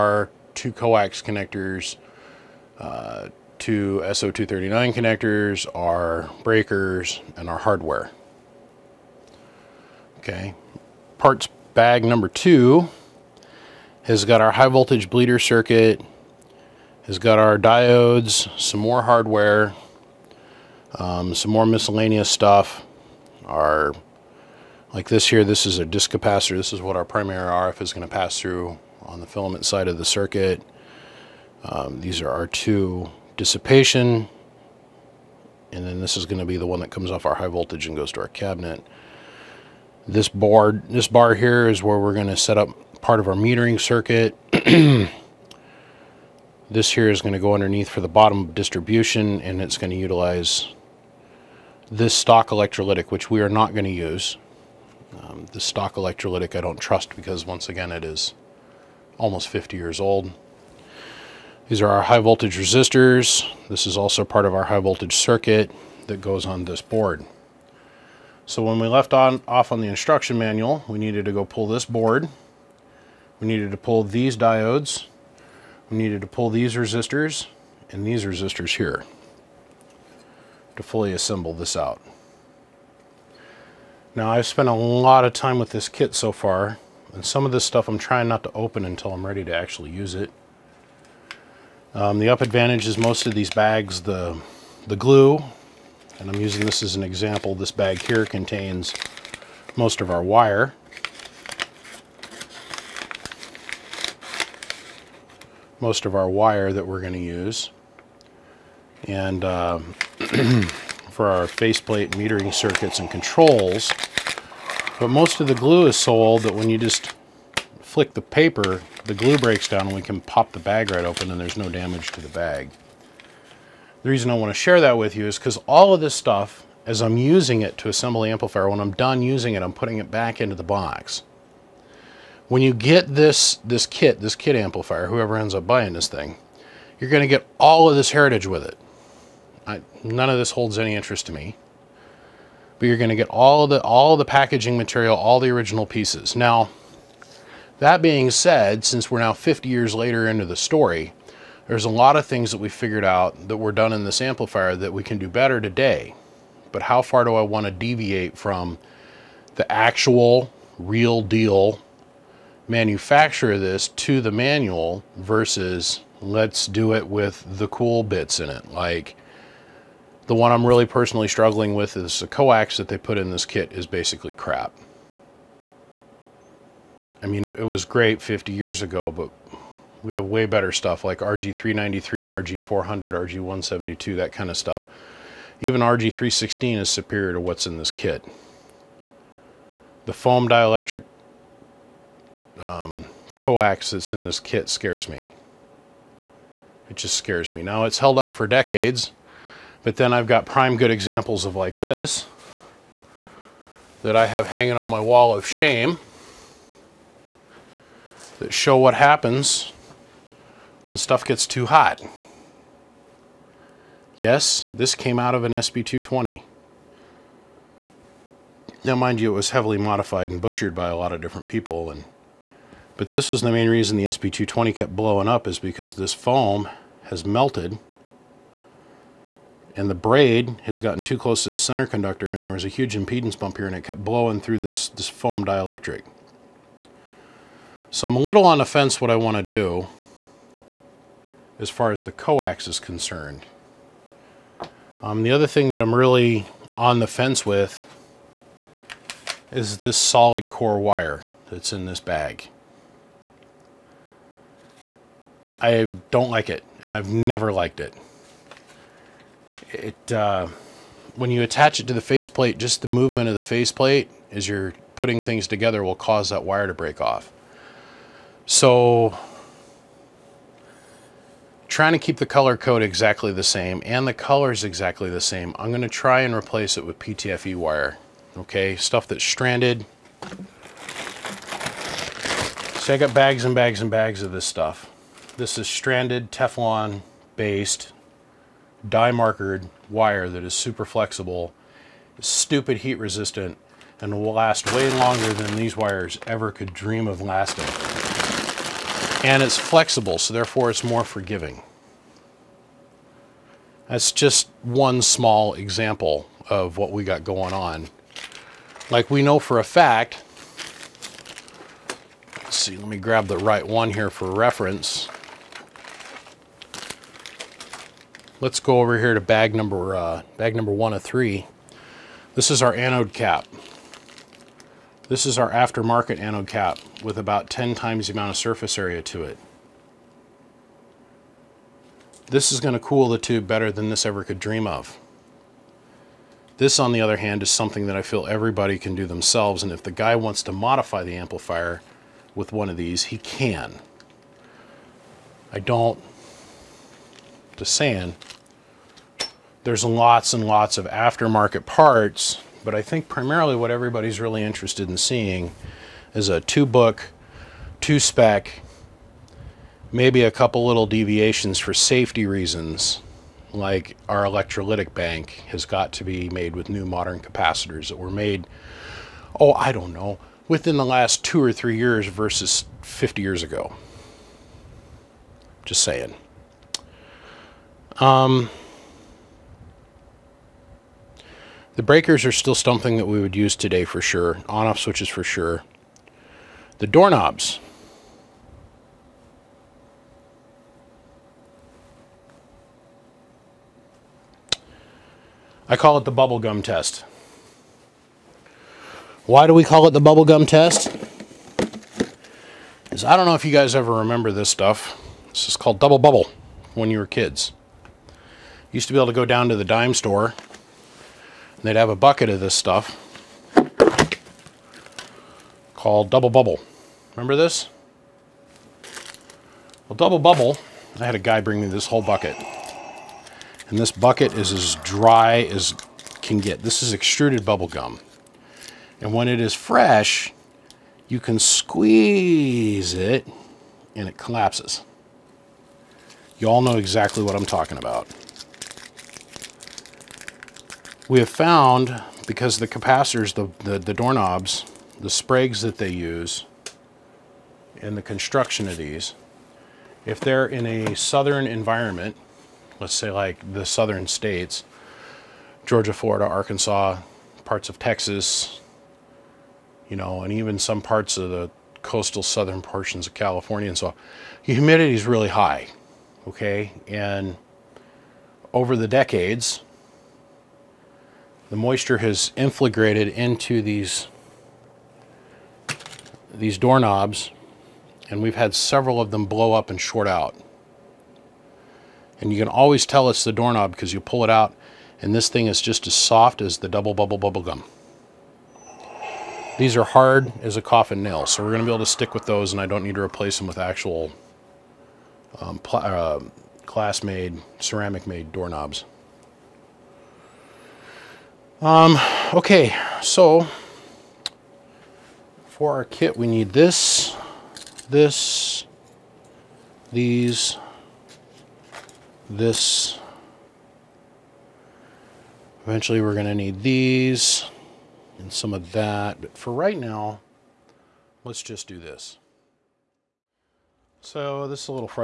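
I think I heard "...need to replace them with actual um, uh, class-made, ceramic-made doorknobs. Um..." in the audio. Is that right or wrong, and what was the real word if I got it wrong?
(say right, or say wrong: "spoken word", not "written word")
right.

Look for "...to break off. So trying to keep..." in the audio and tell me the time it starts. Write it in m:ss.
4:26.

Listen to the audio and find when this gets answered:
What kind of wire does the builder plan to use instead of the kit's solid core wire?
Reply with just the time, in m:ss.
4:36.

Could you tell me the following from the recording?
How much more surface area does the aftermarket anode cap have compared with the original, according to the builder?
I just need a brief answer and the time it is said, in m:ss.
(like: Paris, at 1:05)
About 10 times, at 5:27.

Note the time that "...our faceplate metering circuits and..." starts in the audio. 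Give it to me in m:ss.
1:51.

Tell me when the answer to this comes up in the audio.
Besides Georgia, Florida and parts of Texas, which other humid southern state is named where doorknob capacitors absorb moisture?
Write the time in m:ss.
7:36.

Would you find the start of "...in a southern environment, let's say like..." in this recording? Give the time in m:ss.
7:30.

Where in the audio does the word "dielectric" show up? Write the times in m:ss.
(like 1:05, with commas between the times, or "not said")
3:10, 3:55.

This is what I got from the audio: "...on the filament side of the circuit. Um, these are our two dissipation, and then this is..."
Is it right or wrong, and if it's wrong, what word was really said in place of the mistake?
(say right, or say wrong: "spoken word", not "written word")
right.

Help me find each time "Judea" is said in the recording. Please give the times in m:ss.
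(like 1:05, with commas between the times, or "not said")
not said.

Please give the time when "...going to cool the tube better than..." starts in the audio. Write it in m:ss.
5:32.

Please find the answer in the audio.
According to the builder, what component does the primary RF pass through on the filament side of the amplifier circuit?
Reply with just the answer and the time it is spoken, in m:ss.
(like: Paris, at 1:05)
Disk capacitor, at 0:25.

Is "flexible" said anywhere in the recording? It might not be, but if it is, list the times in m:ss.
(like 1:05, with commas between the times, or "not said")
4:50, 4:59.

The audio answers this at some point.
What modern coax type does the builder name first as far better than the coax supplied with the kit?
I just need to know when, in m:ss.
3:01.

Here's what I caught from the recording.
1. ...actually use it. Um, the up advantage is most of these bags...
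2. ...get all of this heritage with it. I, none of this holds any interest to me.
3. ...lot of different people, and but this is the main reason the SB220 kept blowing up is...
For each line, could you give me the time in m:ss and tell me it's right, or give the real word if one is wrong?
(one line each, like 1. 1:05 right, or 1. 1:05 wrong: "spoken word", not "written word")
1. 1:29 right
2. 2:17 right
3. 3:40 right.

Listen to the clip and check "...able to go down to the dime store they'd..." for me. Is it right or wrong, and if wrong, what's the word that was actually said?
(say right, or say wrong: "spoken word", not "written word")
right.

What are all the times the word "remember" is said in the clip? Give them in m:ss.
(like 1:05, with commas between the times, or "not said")
6:43, 6:57.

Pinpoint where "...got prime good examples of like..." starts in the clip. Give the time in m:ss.
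3:20.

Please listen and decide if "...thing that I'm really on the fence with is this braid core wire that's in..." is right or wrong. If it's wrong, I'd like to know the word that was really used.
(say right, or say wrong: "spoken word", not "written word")
wrong: "solid", not "braid".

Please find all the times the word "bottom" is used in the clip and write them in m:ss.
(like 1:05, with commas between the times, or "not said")
0:48.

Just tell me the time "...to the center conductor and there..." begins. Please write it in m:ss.
3:51.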